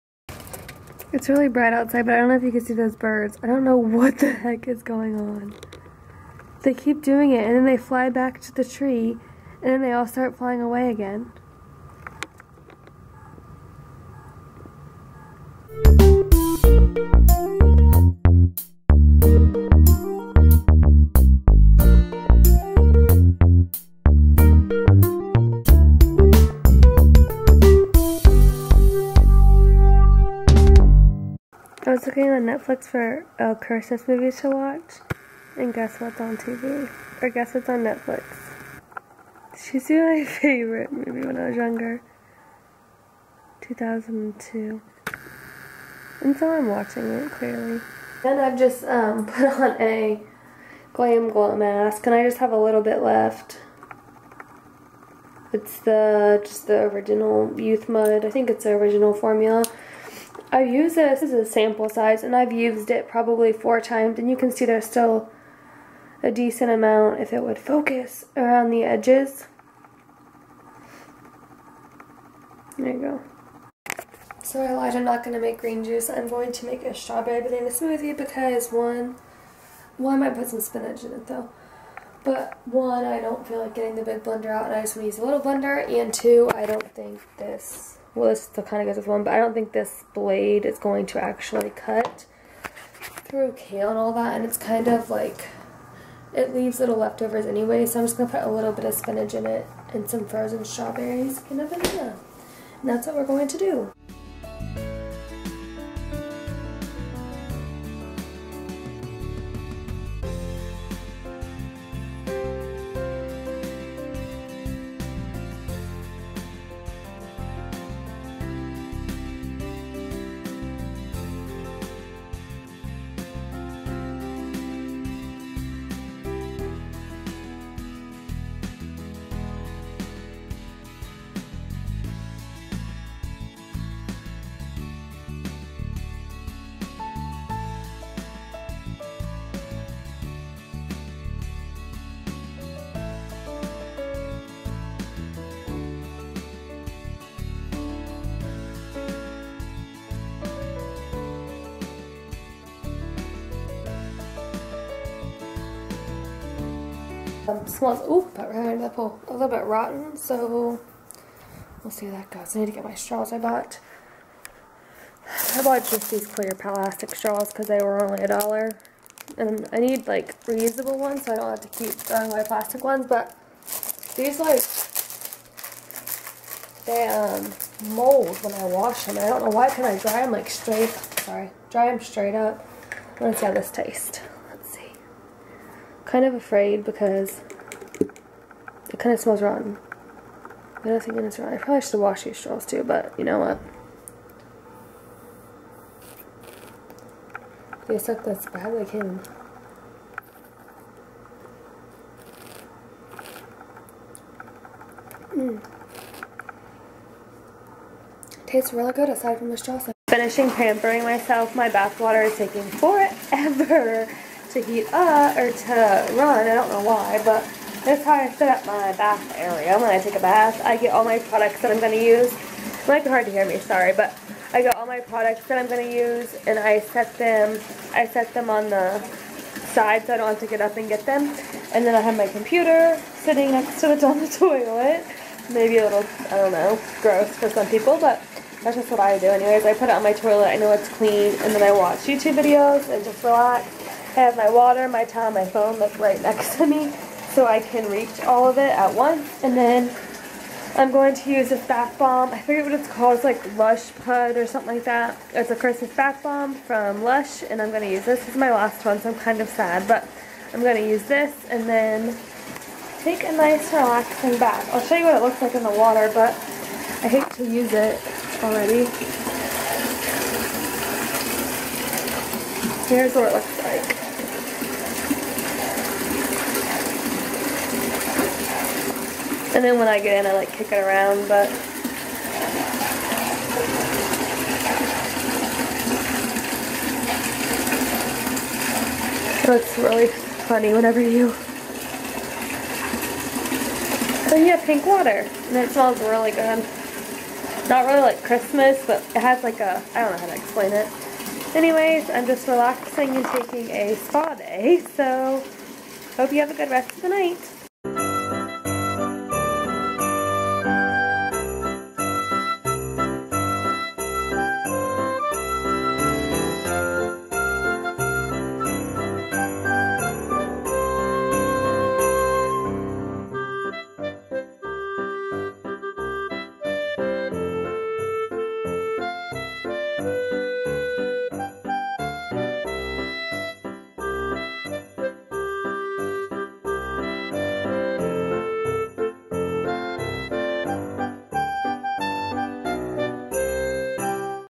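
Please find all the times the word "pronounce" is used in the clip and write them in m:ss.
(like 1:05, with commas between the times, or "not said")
not said.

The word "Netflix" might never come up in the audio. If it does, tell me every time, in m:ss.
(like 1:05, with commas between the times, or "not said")
0:32, 0:37.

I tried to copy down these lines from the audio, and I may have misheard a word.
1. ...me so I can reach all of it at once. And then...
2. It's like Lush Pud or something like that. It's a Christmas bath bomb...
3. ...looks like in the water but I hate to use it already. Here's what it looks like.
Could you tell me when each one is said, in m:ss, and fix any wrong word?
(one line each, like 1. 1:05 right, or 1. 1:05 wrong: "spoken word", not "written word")
1. 4:06 right
2. 4:13 right
3. 4:25 right.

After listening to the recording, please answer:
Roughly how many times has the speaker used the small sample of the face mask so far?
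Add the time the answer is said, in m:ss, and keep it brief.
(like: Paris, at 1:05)
4, at 1:03.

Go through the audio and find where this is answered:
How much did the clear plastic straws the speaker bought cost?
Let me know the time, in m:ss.
2:48.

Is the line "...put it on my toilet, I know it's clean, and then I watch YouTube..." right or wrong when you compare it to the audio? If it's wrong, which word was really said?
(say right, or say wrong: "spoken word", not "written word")
right.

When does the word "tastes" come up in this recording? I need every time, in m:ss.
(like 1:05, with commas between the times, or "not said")
3:03, 3:28.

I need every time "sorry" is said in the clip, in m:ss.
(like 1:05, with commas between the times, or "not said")
3:00, 3:43.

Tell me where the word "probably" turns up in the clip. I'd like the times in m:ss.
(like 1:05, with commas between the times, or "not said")
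1:03, 3:11.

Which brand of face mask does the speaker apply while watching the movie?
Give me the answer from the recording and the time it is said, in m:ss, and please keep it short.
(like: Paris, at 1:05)
GlamGlow, at 0:50.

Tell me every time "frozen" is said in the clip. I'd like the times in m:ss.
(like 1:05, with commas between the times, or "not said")
1:40.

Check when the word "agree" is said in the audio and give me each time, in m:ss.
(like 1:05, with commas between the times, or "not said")
not said.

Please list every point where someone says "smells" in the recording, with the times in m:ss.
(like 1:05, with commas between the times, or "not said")
2:37, 3:09, 4:55.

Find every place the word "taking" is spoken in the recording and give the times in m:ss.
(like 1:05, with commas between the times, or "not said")
3:32, 5:03.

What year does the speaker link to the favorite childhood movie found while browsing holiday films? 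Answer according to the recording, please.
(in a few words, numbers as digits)
2002.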